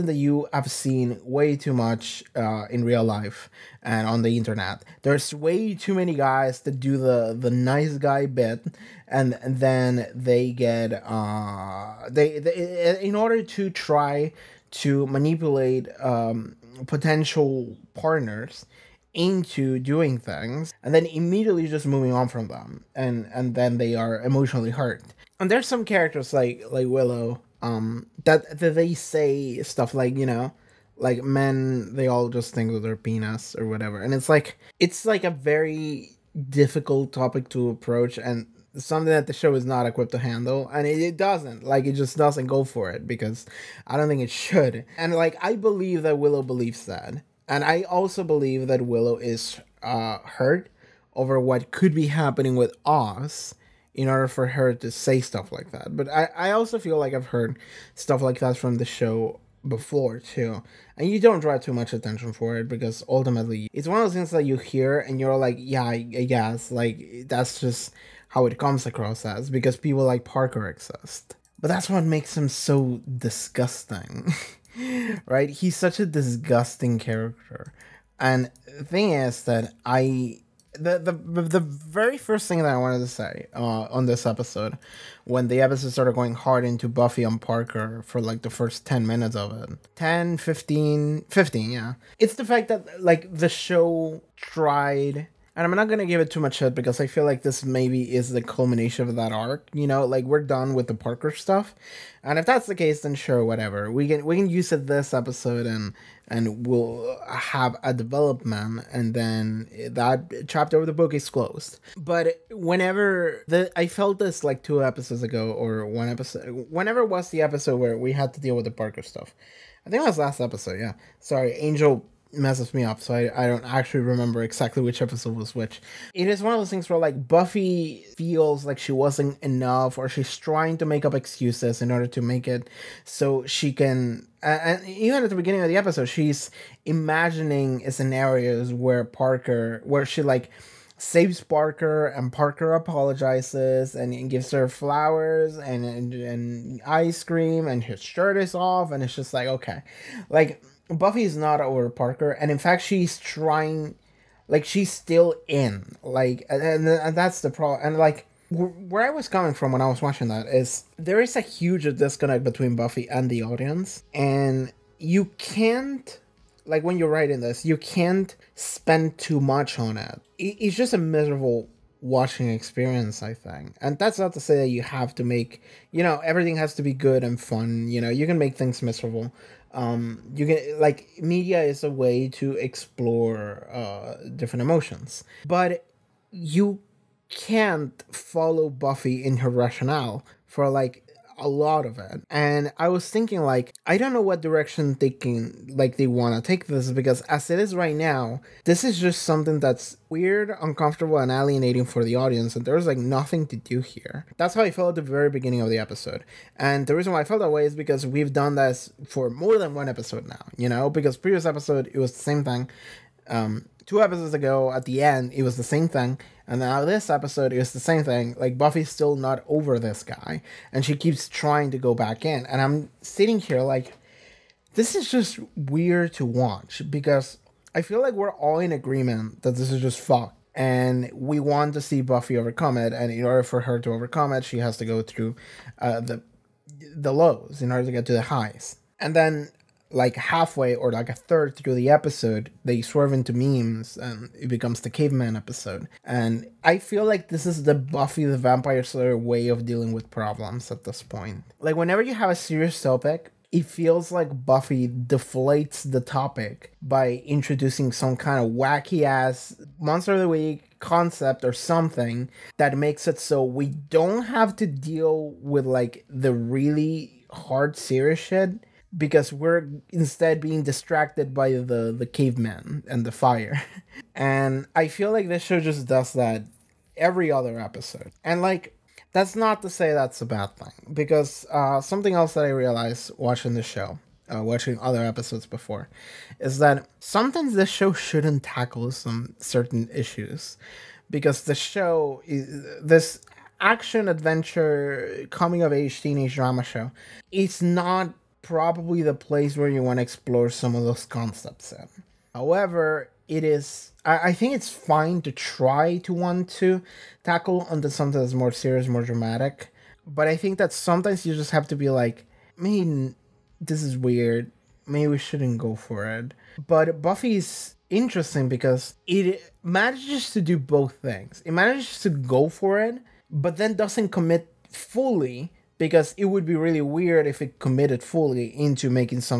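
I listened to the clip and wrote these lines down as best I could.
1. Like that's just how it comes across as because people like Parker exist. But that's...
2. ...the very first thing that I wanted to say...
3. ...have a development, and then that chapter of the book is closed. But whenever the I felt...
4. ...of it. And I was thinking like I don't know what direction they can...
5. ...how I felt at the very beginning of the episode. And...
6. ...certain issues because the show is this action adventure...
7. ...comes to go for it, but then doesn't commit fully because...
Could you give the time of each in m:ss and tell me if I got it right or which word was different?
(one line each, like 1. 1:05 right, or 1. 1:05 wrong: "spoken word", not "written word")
1. 1:06 right
2. 1:21 right
3. 1:47 right
4. 3:11 right
5. 3:24 right
6. 4:49 right
7. 5:21 wrong: "manages", not "comes".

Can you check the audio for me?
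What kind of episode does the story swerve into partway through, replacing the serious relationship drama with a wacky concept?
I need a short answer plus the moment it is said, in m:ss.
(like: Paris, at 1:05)
the caveman episode, at 4:04.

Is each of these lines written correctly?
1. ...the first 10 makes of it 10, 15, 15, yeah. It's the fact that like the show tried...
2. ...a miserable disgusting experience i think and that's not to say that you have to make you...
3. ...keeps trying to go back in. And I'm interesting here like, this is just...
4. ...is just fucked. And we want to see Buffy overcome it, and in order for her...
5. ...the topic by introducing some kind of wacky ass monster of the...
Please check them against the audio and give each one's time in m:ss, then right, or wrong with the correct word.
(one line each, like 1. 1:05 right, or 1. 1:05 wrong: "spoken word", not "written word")
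1. 1:28 wrong: "minutes", not "makes"
2. 2:50 wrong: "watching", not "disgusting"
3. 3:40 wrong: "sitting", not "interesting"
4. 3:49 right
5. 4:15 right.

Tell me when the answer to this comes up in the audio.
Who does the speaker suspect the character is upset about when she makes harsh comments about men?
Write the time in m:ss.
0:52.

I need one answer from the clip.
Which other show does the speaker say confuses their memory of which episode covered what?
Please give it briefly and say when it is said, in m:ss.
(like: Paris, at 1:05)
Angel, at 2:01.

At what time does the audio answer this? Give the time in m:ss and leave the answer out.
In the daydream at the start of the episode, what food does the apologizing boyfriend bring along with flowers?
2:26.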